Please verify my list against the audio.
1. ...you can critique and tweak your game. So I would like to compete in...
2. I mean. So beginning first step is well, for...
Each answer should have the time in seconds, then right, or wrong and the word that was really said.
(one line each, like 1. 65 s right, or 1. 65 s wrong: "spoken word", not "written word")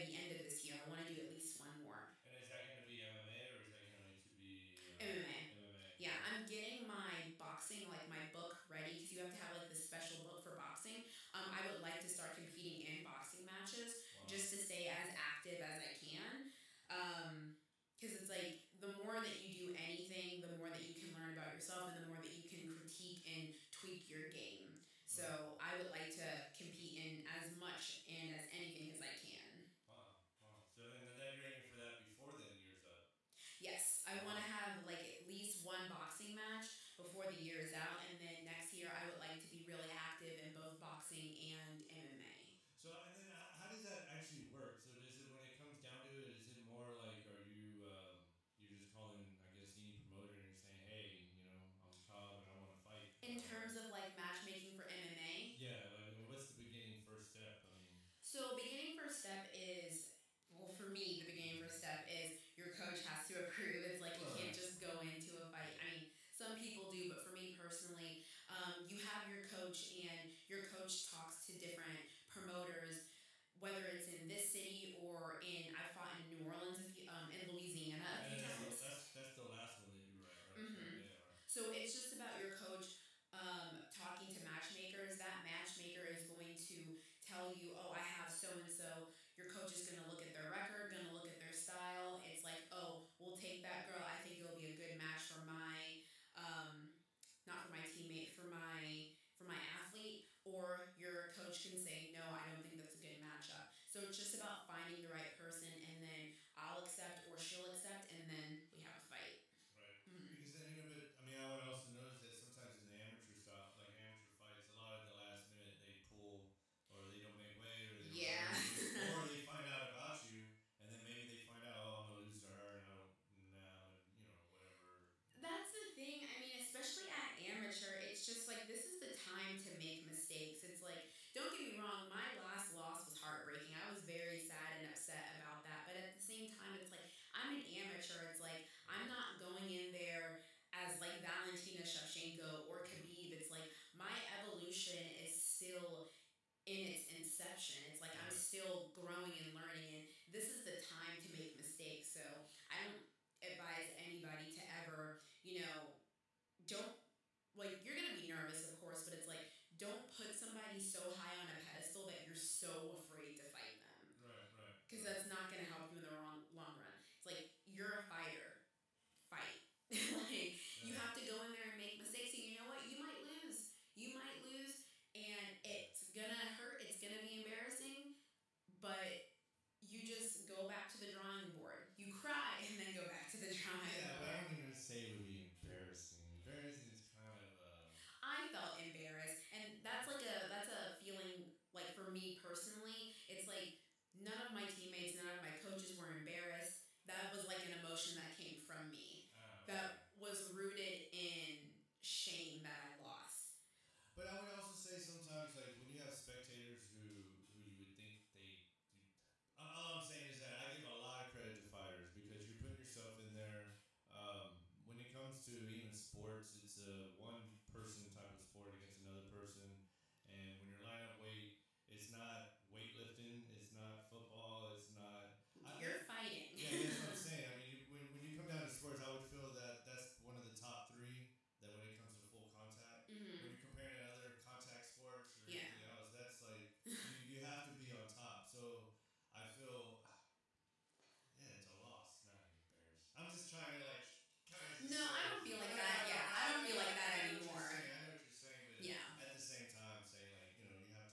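1. 22 s right
2. 57 s right.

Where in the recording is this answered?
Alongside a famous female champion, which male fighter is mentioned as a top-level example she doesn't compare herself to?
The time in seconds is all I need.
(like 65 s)
142 s.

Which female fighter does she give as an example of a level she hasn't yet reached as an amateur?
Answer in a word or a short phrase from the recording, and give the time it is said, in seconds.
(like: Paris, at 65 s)
Valentina Shevchenko, at 141 s.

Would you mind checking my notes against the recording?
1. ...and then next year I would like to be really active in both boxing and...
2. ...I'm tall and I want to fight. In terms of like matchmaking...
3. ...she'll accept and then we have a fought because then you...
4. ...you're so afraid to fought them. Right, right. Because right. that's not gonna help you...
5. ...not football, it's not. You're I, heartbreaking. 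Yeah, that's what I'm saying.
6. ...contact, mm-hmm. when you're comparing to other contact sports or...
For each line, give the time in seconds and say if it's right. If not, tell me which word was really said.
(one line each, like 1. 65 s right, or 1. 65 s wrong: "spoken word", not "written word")
1. 38 s right
2. 51 s right
3. 107 s wrong: "fight", not "fought"
4. 162 s wrong: "fight", not "fought"
5. 223 s wrong: "fighting", not "heartbreaking"
6. 232 s right.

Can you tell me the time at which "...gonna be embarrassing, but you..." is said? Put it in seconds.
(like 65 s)
177 s.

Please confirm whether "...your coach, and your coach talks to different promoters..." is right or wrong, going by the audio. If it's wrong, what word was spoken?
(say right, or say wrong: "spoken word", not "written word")
right.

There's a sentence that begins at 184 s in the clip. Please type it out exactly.
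Yeah, I am going to say would be embarrassing.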